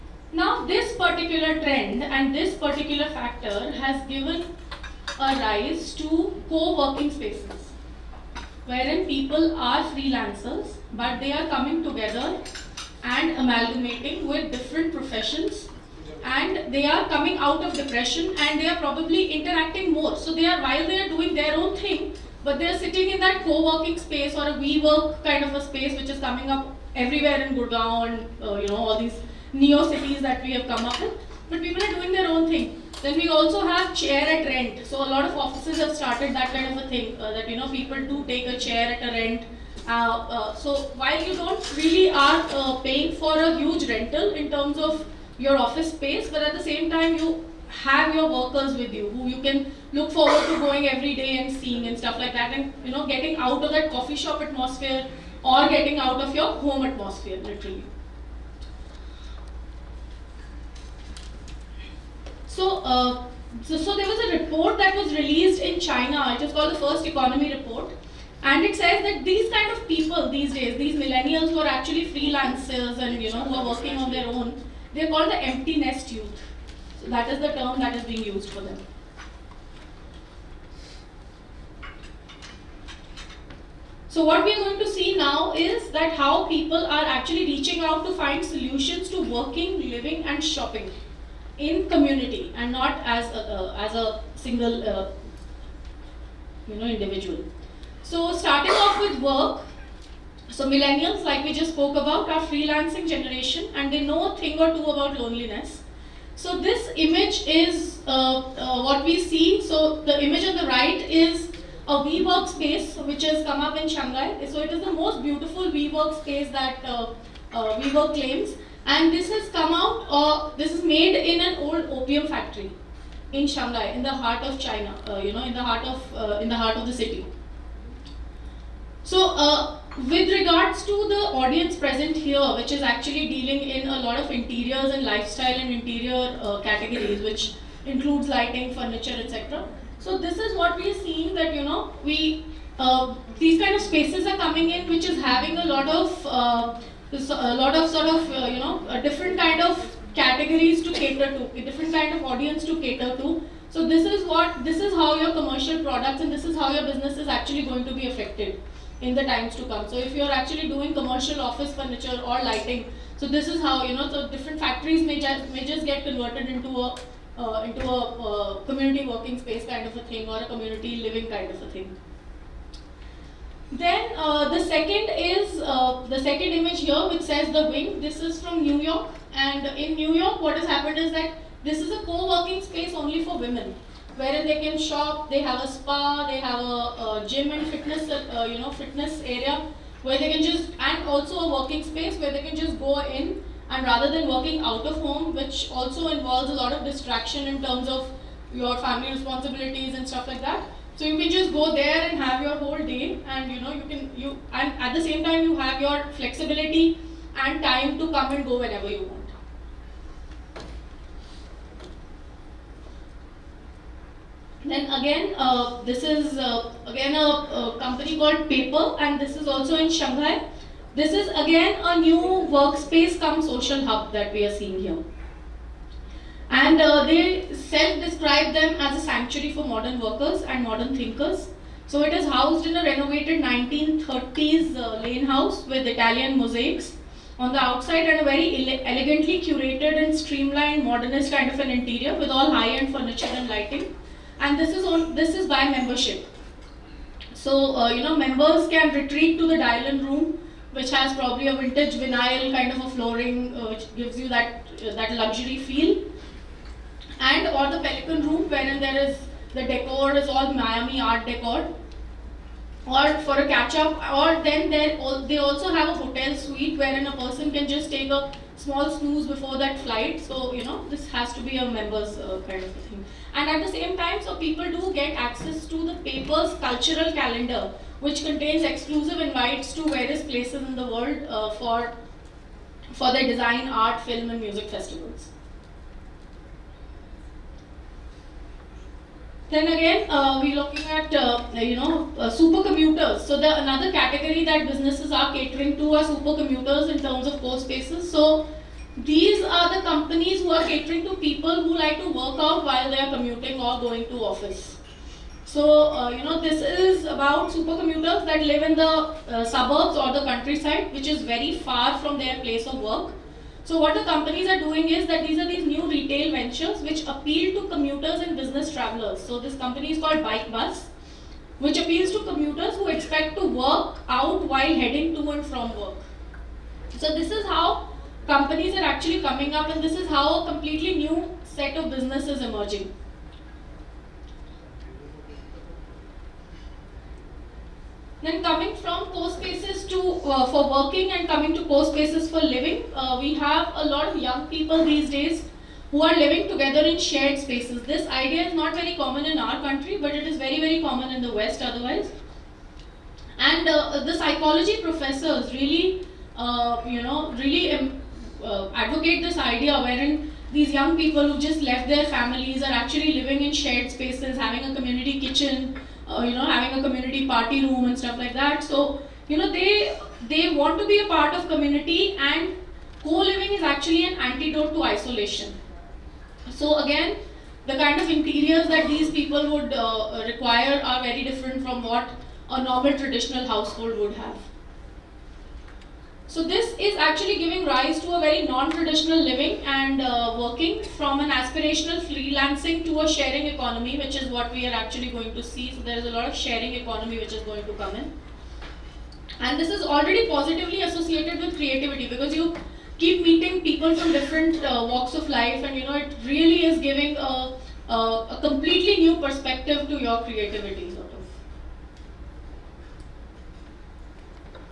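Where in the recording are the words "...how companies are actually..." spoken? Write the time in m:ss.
5:27.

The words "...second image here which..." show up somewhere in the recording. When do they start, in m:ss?
2:56.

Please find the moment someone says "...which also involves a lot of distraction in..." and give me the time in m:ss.
3:15.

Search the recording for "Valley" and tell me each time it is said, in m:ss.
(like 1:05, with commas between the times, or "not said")
not said.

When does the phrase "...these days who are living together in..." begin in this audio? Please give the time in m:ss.
5:44.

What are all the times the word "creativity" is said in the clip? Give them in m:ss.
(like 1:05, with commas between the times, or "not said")
6:41, 6:50.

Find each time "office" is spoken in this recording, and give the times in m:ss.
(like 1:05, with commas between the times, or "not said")
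0:35, 0:45, 2:41, 5:04.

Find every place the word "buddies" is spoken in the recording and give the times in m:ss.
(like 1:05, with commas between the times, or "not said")
not said.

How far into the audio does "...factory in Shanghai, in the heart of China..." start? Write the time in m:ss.
2:02.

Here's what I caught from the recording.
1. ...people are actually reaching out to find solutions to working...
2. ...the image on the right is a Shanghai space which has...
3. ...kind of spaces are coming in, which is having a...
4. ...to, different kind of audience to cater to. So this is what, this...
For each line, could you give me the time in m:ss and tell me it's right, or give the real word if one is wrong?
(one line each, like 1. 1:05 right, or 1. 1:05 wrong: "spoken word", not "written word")
1. 1:26 right
2. 1:50 wrong: "WeWork", not "Shanghai"
3. 2:23 right
4. 2:31 right.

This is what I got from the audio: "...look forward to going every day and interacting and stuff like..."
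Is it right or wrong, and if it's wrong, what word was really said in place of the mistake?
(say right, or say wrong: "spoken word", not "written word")
wrong: "seeing", not "interacting".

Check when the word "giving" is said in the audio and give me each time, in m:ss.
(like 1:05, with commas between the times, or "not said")
6:27, 6:46.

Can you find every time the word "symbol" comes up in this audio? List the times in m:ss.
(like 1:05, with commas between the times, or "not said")
not said.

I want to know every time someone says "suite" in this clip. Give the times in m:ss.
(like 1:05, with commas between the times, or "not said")
4:26.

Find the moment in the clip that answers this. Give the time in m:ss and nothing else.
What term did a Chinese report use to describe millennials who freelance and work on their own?
1:15.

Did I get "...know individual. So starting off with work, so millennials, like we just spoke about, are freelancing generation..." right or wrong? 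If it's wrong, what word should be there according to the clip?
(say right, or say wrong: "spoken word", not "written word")
right.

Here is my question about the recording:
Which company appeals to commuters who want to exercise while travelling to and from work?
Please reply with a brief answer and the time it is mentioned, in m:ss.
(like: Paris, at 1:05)
Bike Bus, at 5:20.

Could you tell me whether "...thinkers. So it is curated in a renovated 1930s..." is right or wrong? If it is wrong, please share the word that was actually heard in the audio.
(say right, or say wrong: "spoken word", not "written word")
wrong: "housed", not "curated".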